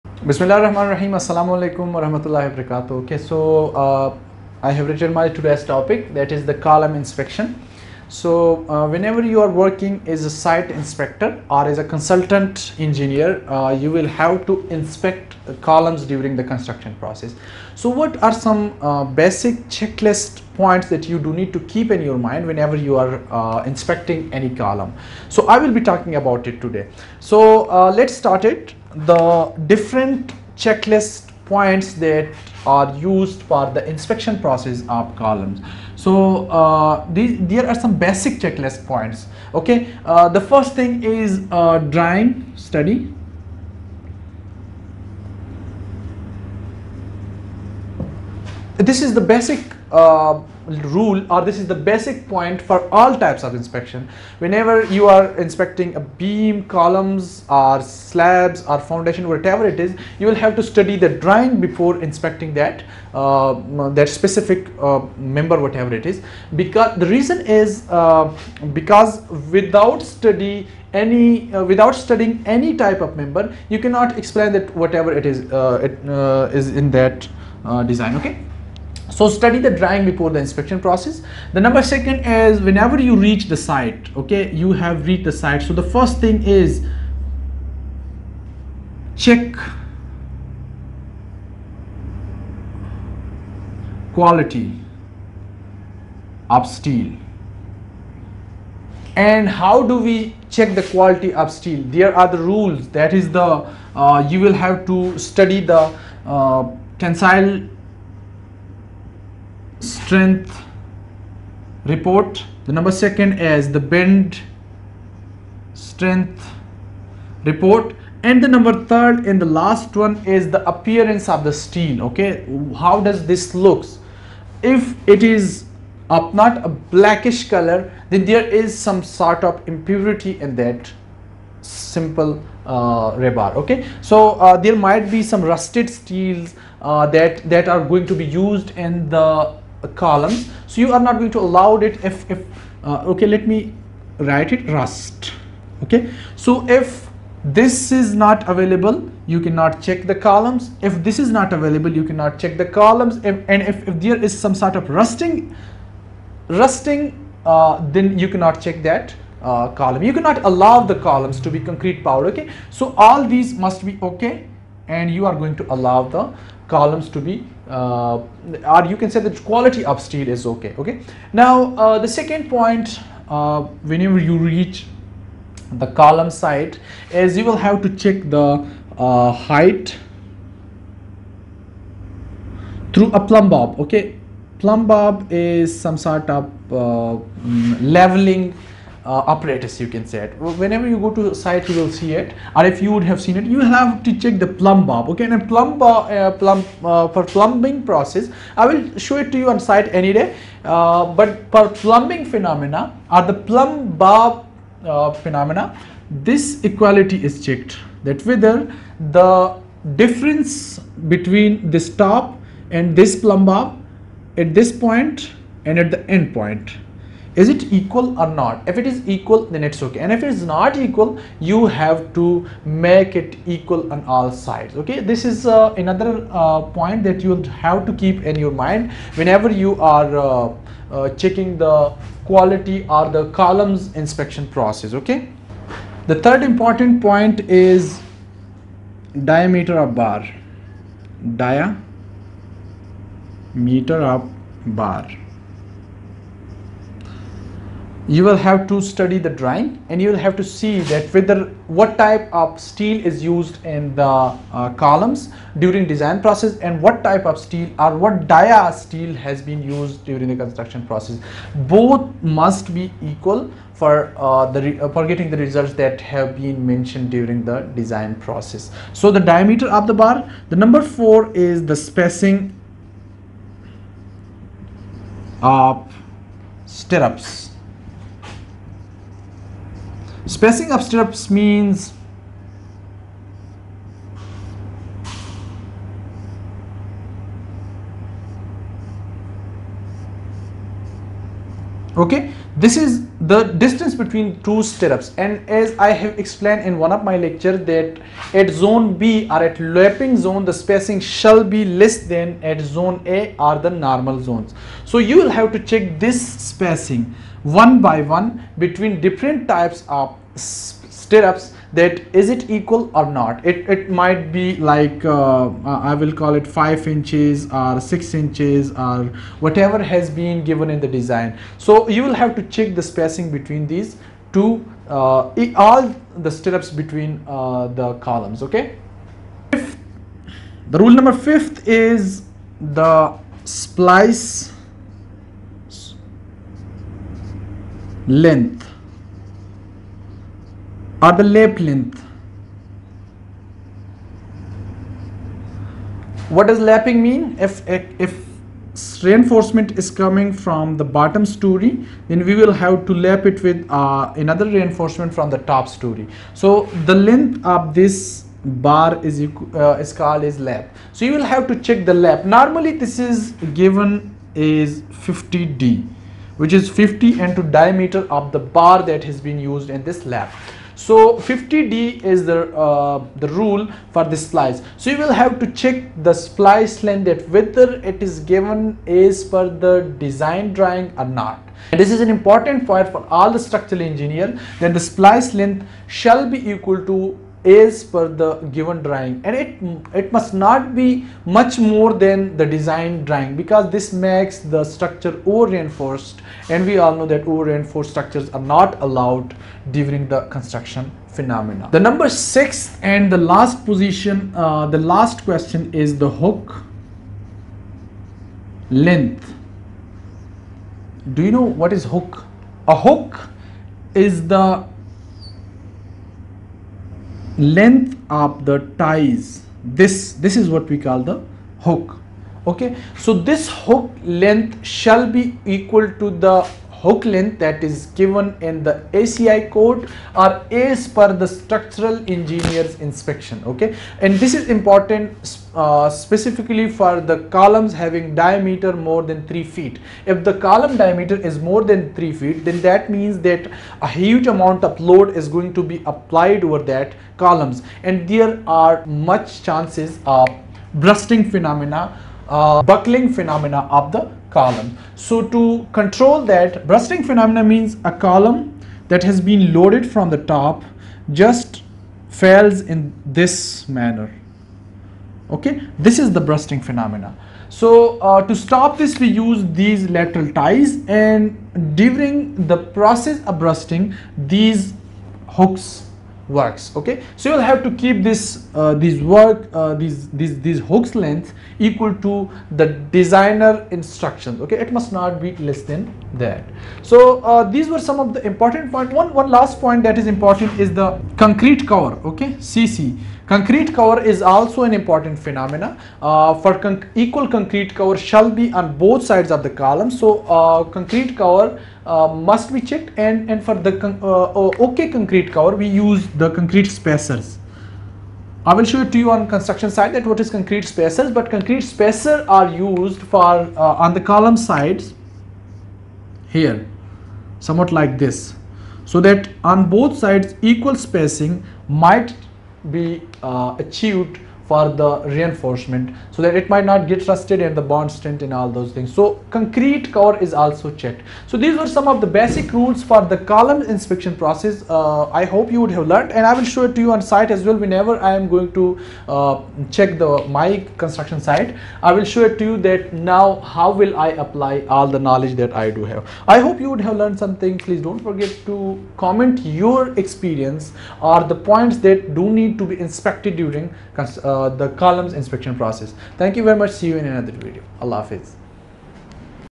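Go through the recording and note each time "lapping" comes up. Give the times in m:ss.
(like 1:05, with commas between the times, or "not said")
4:59, 5:46.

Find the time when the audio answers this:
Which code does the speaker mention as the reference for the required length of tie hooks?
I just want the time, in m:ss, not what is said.
7:08.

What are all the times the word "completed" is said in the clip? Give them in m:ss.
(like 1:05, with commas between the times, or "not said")
not said.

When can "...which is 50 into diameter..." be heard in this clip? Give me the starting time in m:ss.
6:06.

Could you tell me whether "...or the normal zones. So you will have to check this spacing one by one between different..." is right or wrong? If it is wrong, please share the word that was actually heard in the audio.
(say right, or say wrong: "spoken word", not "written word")
right.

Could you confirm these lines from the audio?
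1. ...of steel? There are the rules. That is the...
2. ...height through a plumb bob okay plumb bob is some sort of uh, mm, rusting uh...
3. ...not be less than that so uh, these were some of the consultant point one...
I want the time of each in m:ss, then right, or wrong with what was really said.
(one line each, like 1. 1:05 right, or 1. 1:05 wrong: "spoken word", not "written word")
1. 1:41 right
2. 2:59 wrong: "leveling", not "rusting"
3. 8:04 wrong: "important", not "consultant".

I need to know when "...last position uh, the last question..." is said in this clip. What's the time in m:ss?
6:43.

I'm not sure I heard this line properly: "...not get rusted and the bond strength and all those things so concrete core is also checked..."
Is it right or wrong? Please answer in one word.
right.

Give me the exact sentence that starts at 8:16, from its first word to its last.
Uh, for equal concrete cover shall be on both sides of the column.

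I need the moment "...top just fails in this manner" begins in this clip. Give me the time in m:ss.
7:40.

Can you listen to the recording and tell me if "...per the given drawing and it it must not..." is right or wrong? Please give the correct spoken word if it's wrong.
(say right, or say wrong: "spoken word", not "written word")
right.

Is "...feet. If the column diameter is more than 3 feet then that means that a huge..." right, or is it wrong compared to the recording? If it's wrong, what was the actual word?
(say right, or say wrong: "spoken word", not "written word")
right.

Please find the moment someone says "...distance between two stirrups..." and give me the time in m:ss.
4:53.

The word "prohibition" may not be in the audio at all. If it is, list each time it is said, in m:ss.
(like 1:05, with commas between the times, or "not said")
not said.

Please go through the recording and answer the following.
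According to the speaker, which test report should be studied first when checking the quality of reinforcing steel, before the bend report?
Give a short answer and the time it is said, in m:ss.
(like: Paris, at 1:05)
Tensile strength report, at 1:46.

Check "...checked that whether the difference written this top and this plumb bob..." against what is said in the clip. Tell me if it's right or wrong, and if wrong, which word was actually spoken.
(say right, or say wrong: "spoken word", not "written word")
wrong: "between", not "written".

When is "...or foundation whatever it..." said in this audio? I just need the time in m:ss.
0:58.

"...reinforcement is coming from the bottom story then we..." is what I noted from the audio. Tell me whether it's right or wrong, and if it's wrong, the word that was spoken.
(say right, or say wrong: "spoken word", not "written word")
right.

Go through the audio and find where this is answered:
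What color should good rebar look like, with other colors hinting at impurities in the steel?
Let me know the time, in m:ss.
2:06.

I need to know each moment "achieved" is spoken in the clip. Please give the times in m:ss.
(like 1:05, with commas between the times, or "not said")
8:43.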